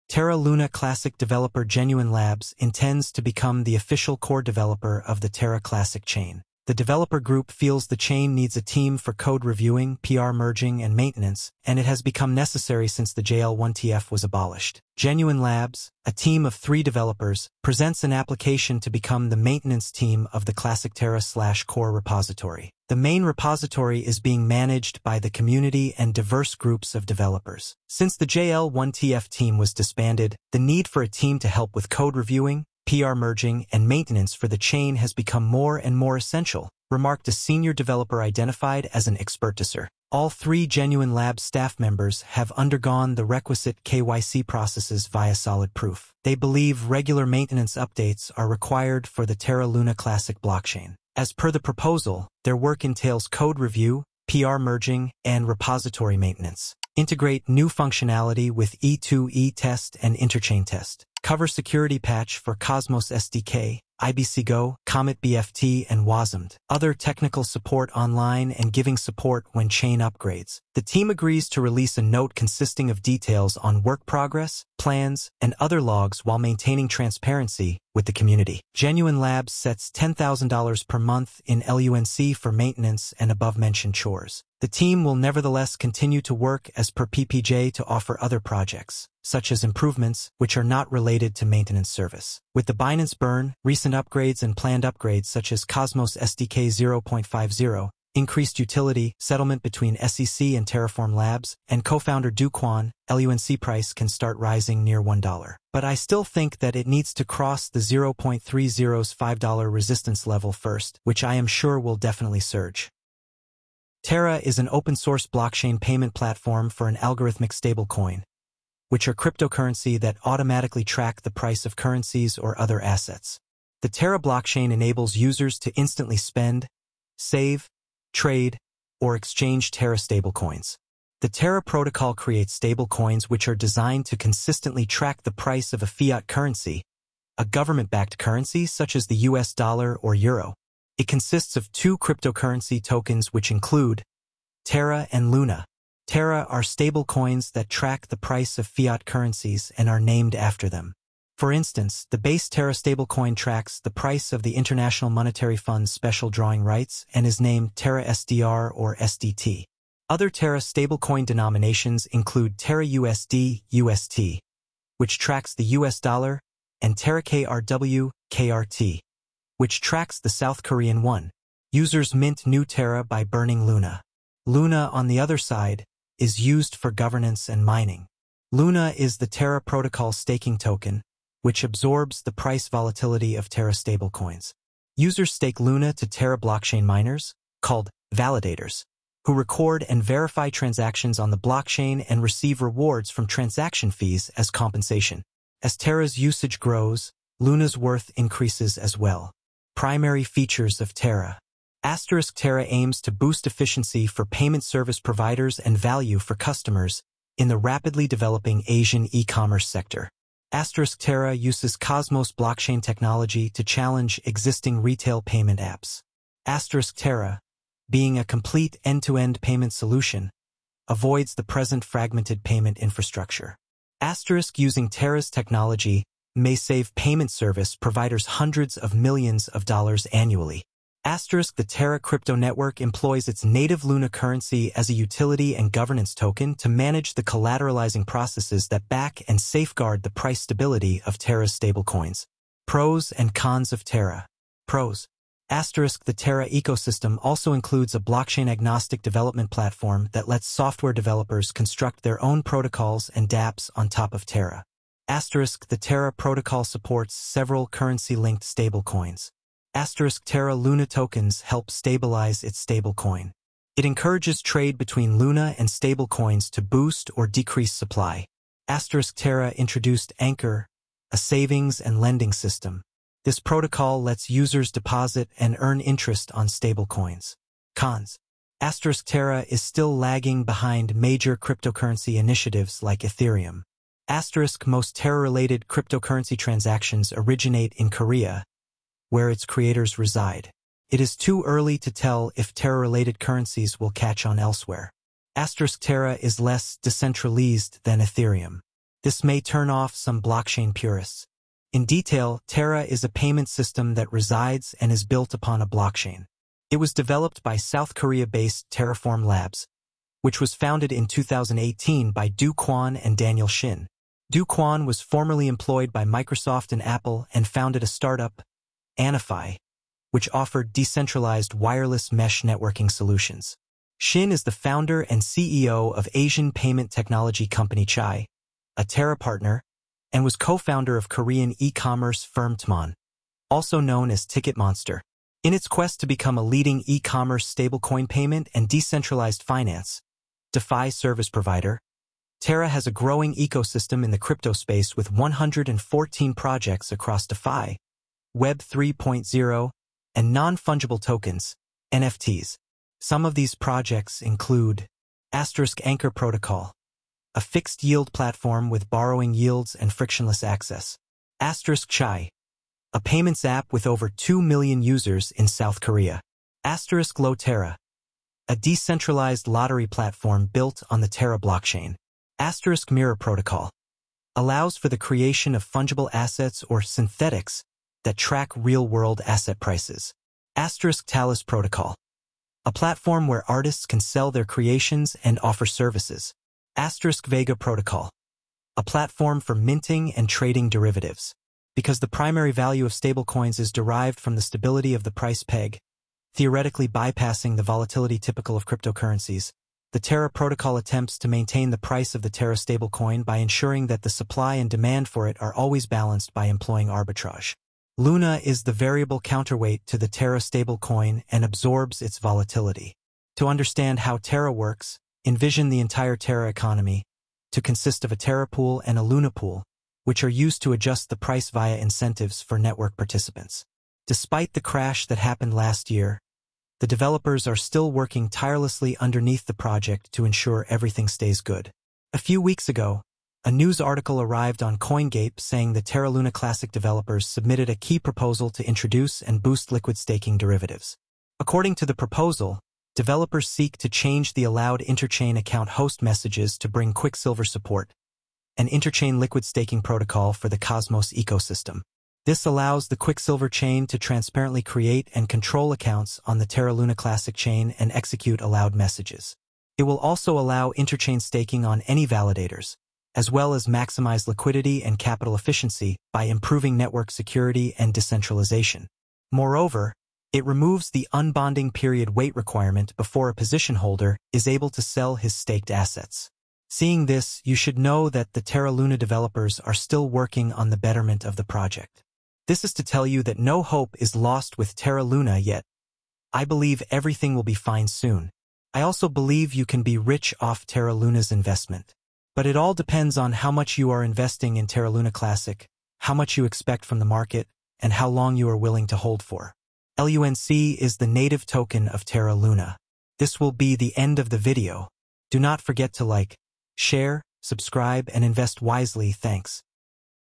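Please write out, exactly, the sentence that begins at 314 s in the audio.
Do Kwon was formerly employed by Microsoft and Apple and founded a startup, Anyfi, which offered decentralized wireless mesh networking solutions.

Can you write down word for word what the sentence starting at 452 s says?
This allows the Quicksilver chain to transparently create and control accounts on the Terra Luna Classic chain and execute allowed messages.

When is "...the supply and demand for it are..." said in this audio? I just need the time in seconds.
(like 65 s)
404 s.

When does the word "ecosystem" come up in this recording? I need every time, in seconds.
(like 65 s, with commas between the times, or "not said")
246 s, 343 s, 451 s.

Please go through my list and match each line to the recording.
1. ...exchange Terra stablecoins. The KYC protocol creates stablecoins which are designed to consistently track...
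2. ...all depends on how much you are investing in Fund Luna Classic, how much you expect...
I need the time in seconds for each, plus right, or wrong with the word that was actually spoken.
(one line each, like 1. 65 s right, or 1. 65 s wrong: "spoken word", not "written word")
1. 129 s wrong: "Terra", not "KYC"
2. 492 s wrong: "Terra", not "Fund".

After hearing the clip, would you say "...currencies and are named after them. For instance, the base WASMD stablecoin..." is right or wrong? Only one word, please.
wrong.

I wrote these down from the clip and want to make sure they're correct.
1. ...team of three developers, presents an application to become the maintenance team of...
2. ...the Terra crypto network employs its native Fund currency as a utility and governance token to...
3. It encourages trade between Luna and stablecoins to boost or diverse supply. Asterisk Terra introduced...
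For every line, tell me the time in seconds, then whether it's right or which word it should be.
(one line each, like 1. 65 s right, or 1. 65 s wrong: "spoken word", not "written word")
1. 16 s right
2. 231 s wrong: "Luna", not "Fund"
3. 263 s wrong: "decrease", not "diverse".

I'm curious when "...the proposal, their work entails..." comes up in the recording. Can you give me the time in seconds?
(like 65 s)
51 s.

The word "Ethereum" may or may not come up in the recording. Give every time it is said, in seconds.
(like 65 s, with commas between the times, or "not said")
283 s, 297 s.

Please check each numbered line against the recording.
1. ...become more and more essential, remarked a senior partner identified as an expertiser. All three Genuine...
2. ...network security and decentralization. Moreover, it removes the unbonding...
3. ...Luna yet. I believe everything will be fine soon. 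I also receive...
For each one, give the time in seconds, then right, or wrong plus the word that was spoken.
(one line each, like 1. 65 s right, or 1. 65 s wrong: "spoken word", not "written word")
1. 35 s wrong: "developer", not "partner"
2. 466 s right
3. 485 s wrong: "believe", not "receive".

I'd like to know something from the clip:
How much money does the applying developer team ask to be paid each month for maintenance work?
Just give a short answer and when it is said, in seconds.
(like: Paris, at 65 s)
$10,000, at 79 s.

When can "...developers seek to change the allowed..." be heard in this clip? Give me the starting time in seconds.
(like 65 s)
442 s.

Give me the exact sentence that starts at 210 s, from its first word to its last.
Asterisk Terra uses Cosmos blockchain technology to challenge existing retail payment apps.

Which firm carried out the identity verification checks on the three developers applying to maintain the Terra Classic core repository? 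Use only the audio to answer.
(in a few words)
SolidProof.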